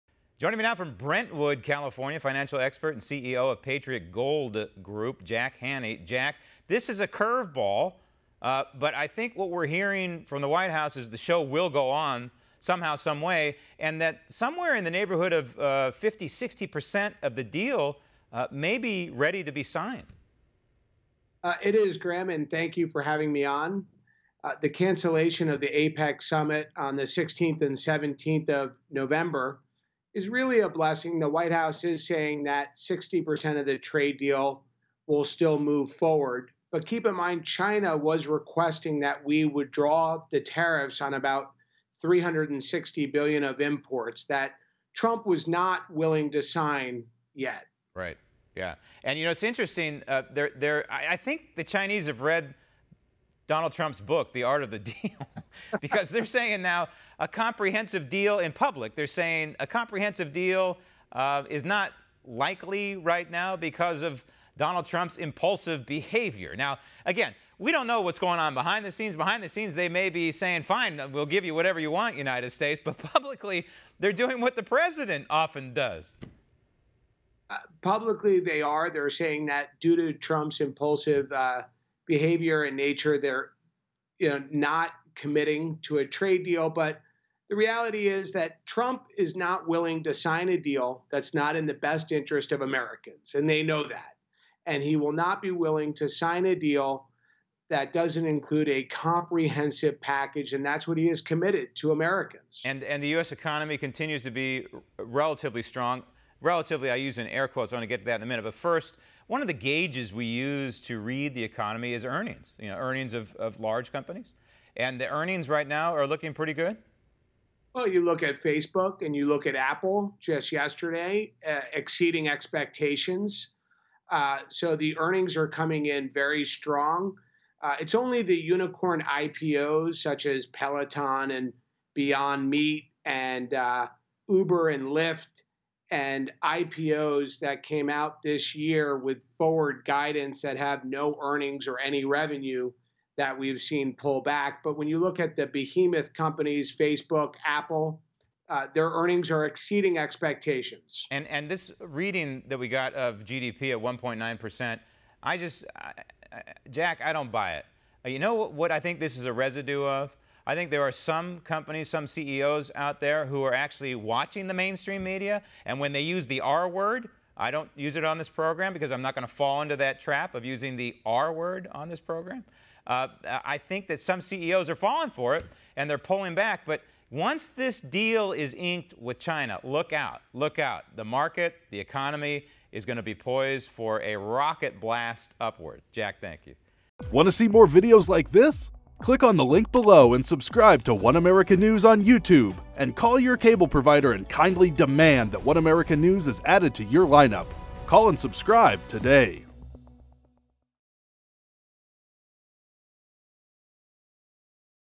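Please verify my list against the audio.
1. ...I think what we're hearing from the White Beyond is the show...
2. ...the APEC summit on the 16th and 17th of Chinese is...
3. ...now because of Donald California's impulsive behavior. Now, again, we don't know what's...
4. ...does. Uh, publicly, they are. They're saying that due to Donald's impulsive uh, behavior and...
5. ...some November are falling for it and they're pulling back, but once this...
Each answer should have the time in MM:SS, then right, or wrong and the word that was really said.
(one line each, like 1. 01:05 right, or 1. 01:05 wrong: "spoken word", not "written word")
1. 00:08 wrong: "House", not "Beyond"
2. 00:25 wrong: "November", not "Chinese"
3. 01:03 wrong: "Trump", not "California"
4. 01:15 wrong: "Trump", not "Donald"
5. 02:53 wrong: "CEOs", not "November".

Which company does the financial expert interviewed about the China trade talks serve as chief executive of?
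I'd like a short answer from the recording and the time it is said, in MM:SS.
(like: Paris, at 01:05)
Patriot Gold Group, at 00:03.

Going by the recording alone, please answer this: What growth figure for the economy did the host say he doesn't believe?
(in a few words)
1.9 percent.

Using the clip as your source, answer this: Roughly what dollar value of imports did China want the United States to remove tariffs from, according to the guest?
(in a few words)
360 billion.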